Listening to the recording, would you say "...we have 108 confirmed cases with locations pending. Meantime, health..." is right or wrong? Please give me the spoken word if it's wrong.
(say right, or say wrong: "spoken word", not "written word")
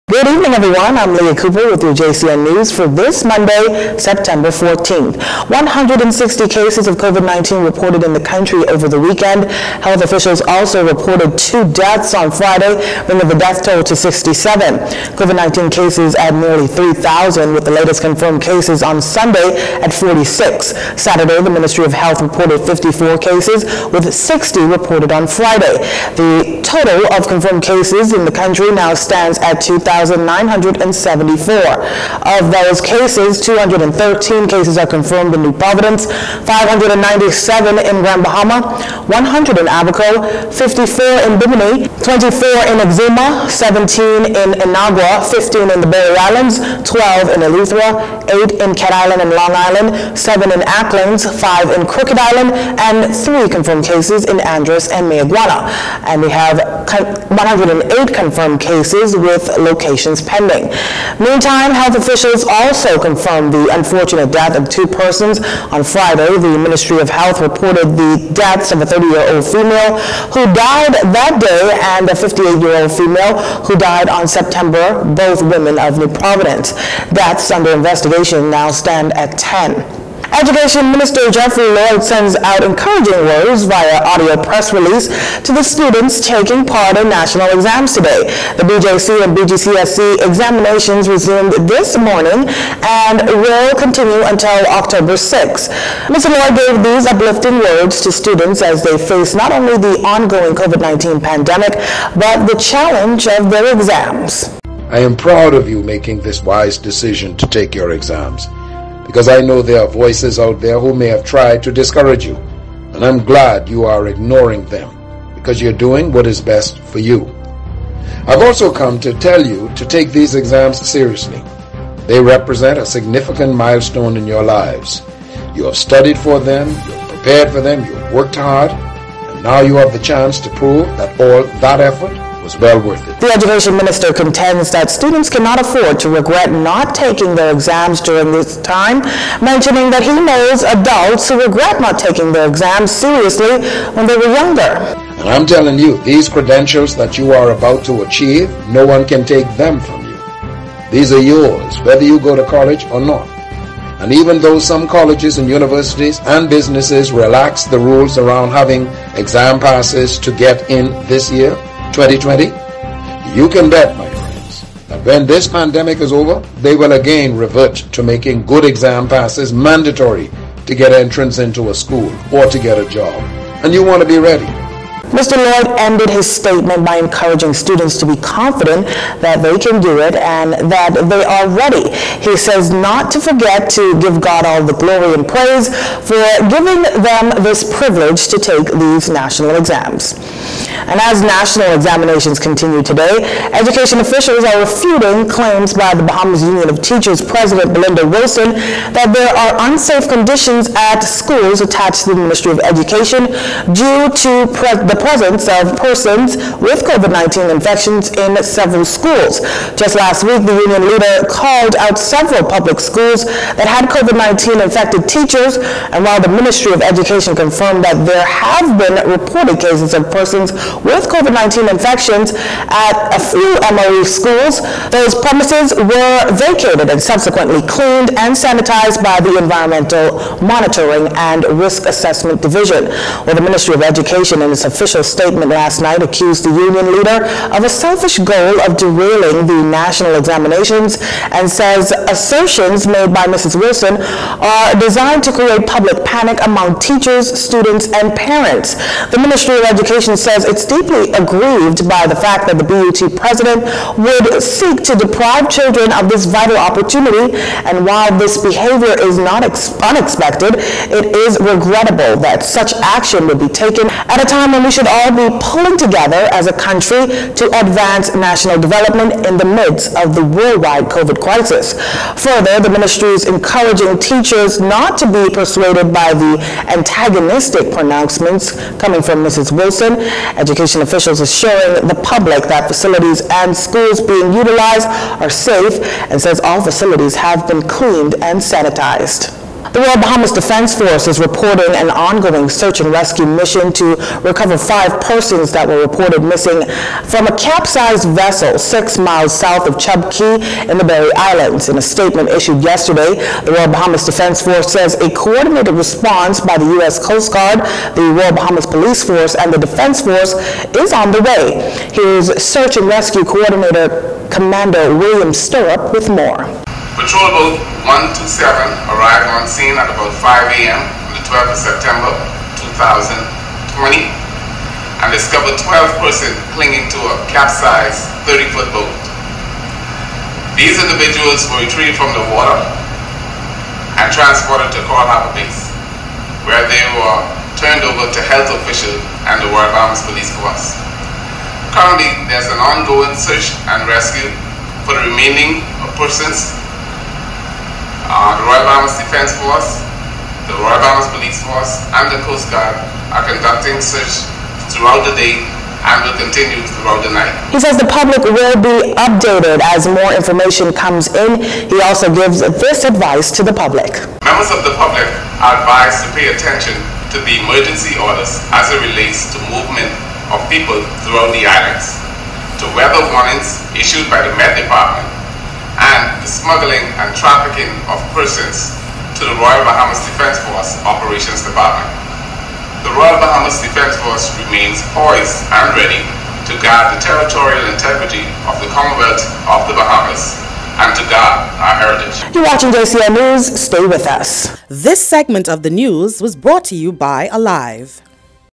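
right.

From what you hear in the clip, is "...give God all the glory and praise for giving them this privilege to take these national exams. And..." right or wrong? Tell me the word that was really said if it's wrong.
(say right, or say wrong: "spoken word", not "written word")
right.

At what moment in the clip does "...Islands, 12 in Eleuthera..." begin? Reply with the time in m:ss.
0:46.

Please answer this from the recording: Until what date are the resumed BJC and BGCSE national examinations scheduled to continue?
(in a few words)
October 6.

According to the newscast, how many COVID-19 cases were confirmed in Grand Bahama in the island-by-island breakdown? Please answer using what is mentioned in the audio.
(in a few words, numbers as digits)
597.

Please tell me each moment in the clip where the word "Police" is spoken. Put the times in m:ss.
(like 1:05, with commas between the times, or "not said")
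5:08, 5:40, 5:51.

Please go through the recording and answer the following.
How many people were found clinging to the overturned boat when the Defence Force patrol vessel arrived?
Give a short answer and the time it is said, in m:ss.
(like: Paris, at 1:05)
12, at 5:25.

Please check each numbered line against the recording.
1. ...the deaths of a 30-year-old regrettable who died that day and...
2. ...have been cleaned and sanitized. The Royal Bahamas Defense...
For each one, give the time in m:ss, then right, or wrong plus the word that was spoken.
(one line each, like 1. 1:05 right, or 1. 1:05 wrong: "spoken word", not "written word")
1. 1:07 wrong: "female", not "regrettable"
2. 4:47 right.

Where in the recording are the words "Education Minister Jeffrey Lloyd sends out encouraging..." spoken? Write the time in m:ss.
1:20.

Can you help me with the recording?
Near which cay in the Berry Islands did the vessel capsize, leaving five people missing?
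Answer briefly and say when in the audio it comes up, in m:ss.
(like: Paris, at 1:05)
Chub Cay, at 4:59.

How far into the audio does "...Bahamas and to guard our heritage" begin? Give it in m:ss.
6:29.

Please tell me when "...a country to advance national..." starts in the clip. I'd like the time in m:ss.
4:26.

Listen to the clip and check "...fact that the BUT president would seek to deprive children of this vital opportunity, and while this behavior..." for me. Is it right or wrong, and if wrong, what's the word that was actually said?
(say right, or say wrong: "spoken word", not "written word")
right.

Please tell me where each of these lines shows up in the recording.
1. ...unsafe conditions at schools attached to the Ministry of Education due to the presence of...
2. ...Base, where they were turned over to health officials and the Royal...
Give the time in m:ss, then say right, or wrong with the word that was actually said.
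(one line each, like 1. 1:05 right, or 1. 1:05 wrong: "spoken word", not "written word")
1. 3:19 right
2. 5:35 right.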